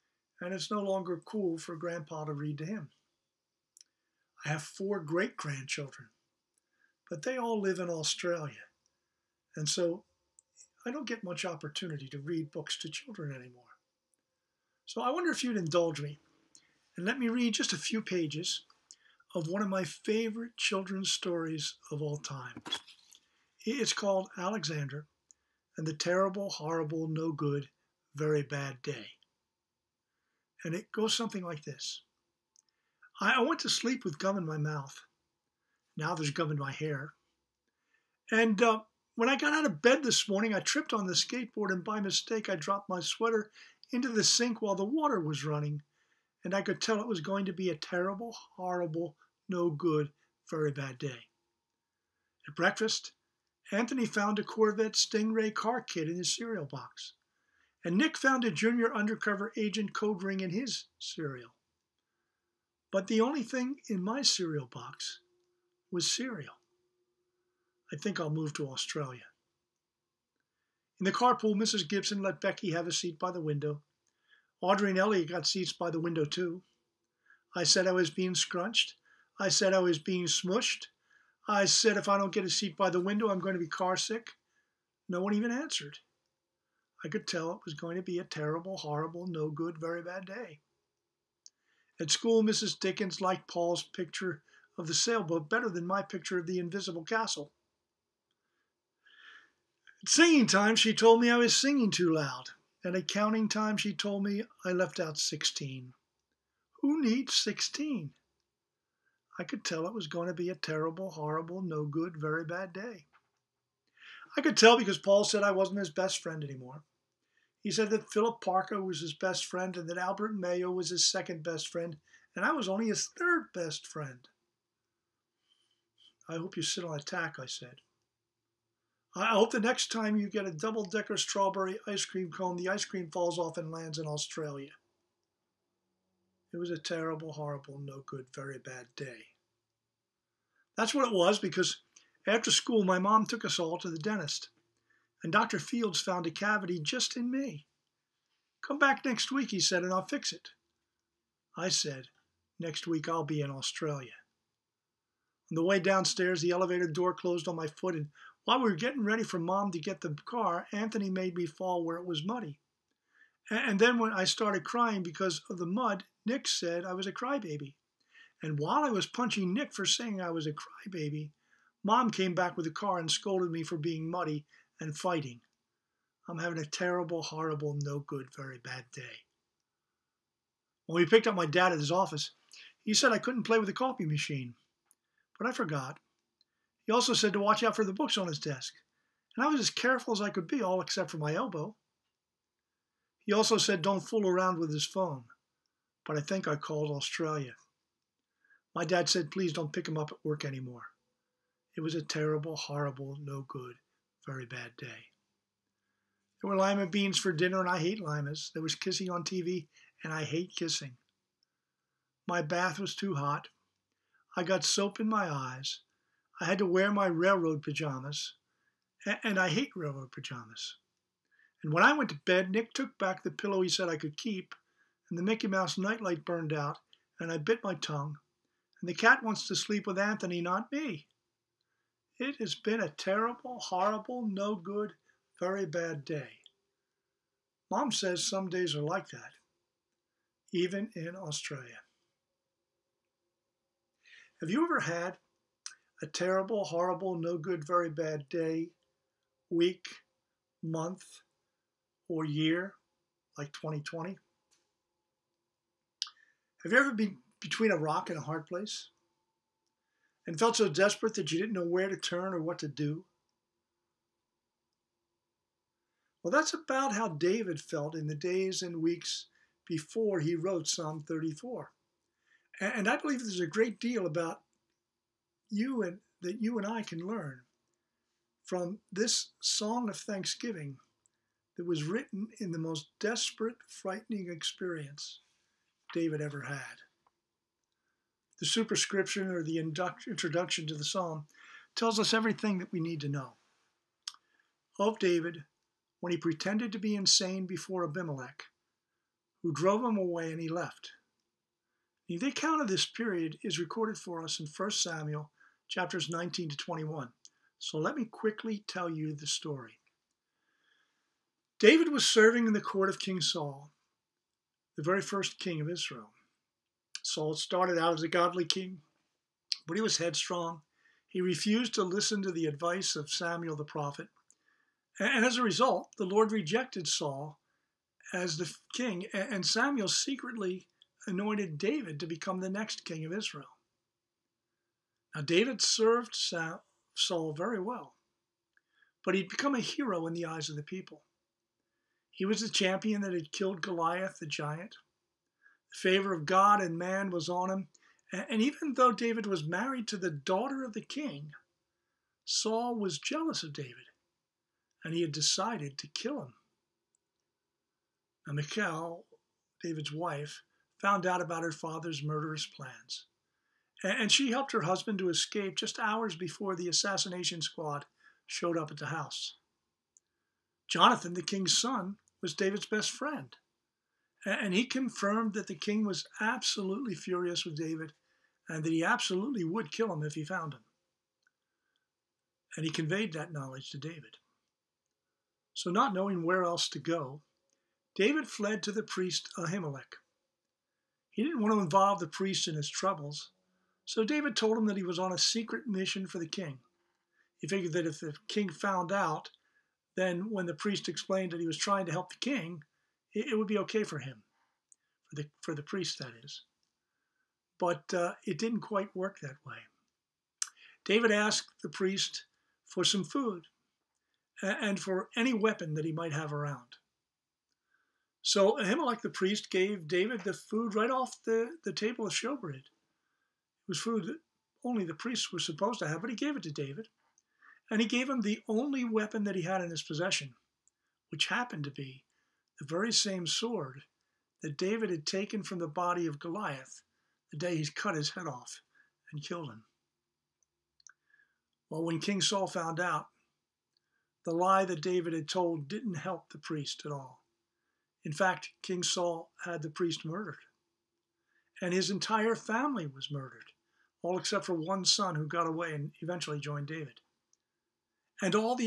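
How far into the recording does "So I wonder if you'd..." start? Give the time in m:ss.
0:14.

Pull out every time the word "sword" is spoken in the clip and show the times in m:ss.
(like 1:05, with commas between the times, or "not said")
7:13.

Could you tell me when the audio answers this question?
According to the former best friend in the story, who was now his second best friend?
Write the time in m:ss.
1:59.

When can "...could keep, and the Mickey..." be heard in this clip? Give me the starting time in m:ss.
3:43.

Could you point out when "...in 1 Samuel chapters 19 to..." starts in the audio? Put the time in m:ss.
5:04.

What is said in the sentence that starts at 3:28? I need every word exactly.
There was kissing on TV, and I hate kissing.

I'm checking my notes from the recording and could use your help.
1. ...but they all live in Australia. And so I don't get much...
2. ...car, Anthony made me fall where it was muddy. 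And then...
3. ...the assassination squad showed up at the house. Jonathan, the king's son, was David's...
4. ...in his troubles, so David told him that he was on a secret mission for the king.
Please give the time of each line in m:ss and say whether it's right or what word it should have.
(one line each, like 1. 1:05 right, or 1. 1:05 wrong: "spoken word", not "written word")
1. 0:07 right
2. 2:40 right
3. 6:06 right
4. 6:32 right.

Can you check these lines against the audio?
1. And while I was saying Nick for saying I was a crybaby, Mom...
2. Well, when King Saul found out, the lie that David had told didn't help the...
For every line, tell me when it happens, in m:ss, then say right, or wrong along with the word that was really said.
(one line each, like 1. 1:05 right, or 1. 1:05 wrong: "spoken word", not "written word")
1. 2:48 wrong: "punching", not "saying"
2. 7:21 right.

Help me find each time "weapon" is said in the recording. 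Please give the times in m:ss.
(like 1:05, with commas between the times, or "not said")
6:55, 7:08.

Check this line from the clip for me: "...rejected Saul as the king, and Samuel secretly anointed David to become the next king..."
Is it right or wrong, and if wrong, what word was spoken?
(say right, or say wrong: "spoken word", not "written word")
right.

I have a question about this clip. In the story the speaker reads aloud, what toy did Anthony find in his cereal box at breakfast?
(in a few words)
Corvette Stingray car kit.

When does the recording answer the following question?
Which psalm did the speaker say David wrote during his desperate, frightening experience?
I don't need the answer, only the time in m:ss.
4:30.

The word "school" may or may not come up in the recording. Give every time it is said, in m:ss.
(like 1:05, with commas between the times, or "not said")
1:32, 2:22.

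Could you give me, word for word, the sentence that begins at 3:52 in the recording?
It has been a terrible, horrible, no good, very bad day.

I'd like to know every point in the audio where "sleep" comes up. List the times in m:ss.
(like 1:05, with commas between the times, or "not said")
0:33, 3:49.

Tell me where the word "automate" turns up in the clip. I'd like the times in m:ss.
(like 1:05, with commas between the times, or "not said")
not said.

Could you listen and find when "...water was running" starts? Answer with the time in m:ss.
0:44.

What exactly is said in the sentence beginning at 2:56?
I'm having a terrible, horrible, no good, very bad day.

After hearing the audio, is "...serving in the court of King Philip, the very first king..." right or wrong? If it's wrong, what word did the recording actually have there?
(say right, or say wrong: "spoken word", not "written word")
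wrong: "Saul", not "Philip".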